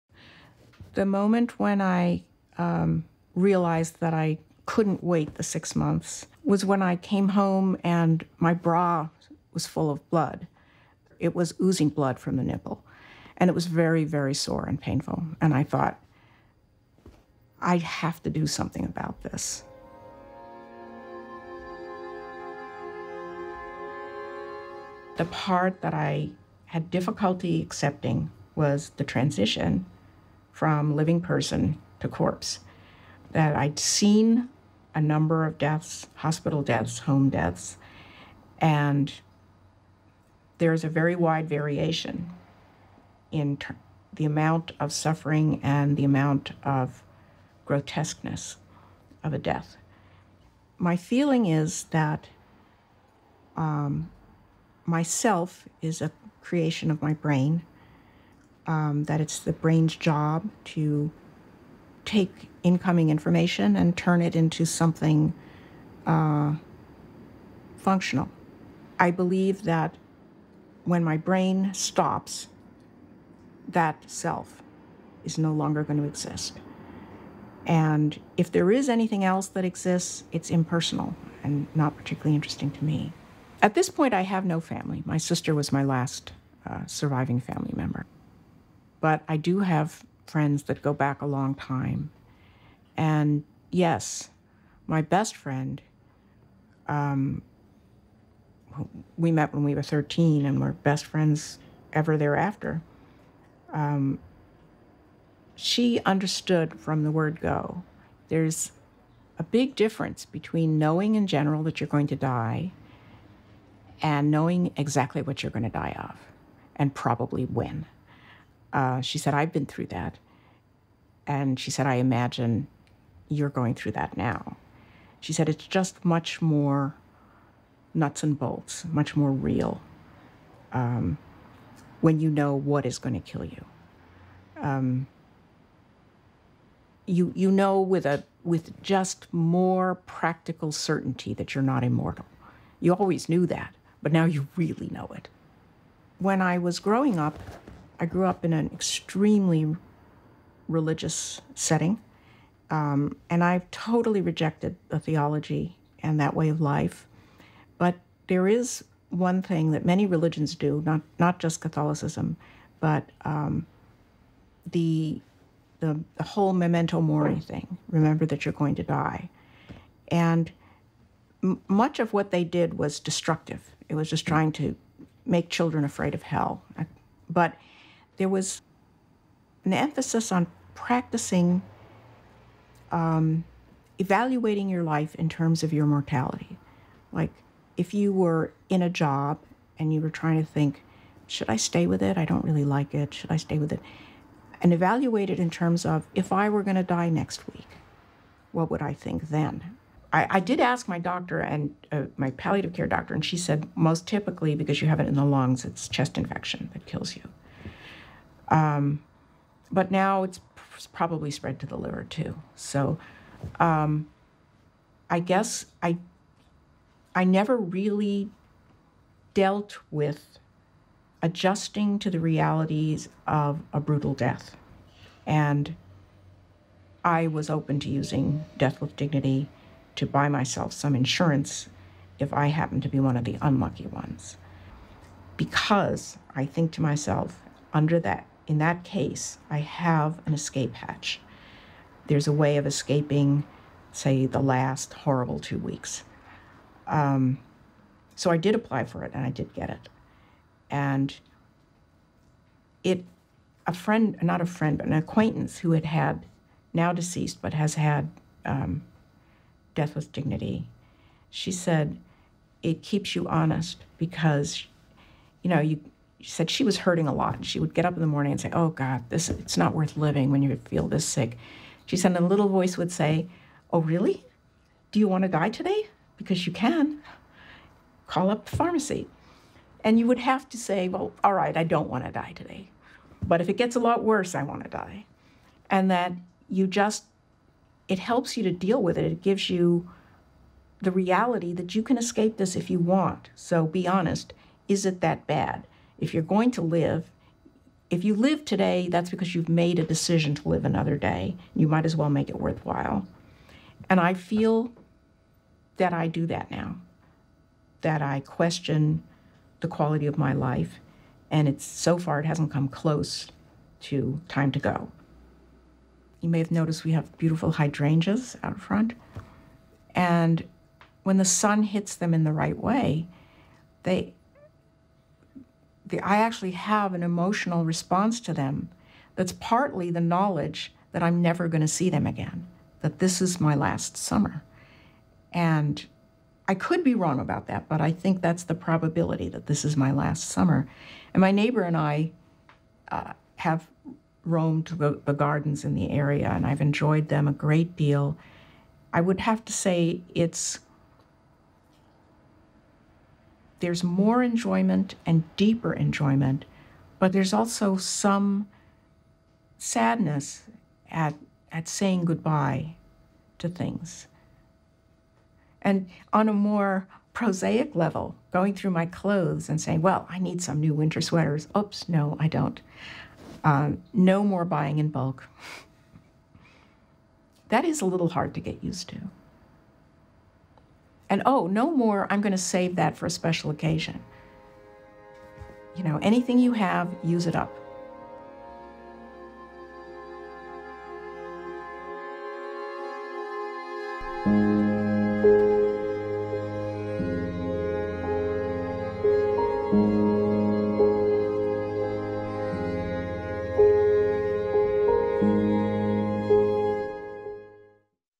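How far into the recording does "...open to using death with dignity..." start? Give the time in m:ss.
3:47.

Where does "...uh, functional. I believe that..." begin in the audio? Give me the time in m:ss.
1:06.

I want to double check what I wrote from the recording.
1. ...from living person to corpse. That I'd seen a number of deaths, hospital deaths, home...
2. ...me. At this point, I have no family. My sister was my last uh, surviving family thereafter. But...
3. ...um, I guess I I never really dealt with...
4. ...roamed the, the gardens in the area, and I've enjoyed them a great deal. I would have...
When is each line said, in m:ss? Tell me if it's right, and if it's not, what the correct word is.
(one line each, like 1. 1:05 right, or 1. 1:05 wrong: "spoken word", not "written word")
1. 0:30 right
2. 1:22 wrong: "member", not "thereafter"
3. 3:33 right
4. 5:44 right.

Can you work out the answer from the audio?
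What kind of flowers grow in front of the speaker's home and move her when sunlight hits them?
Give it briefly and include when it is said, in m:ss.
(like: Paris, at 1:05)
Hydrangeas, at 5:17.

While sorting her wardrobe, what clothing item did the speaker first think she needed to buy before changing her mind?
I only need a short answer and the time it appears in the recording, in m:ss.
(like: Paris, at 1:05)
Winter sweaters, at 6:10.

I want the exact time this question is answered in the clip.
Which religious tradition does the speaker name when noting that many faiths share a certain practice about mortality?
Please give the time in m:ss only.
2:41.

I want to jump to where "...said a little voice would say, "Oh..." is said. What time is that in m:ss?
4:31.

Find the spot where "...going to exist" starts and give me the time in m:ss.
1:15.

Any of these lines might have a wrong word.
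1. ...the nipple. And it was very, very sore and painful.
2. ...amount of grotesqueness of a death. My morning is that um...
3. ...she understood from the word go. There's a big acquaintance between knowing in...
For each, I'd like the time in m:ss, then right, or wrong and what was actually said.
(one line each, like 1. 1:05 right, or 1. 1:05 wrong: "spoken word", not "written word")
1. 0:12 right
2. 0:46 wrong: "feeling", not "morning"
3. 1:45 wrong: "difference", not "acquaintance".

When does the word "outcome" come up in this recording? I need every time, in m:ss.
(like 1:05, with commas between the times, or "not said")
not said.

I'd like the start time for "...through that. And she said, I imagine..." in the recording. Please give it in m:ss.
1:59.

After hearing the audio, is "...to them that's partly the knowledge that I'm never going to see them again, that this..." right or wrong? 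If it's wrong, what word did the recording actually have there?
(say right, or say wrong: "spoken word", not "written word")
right.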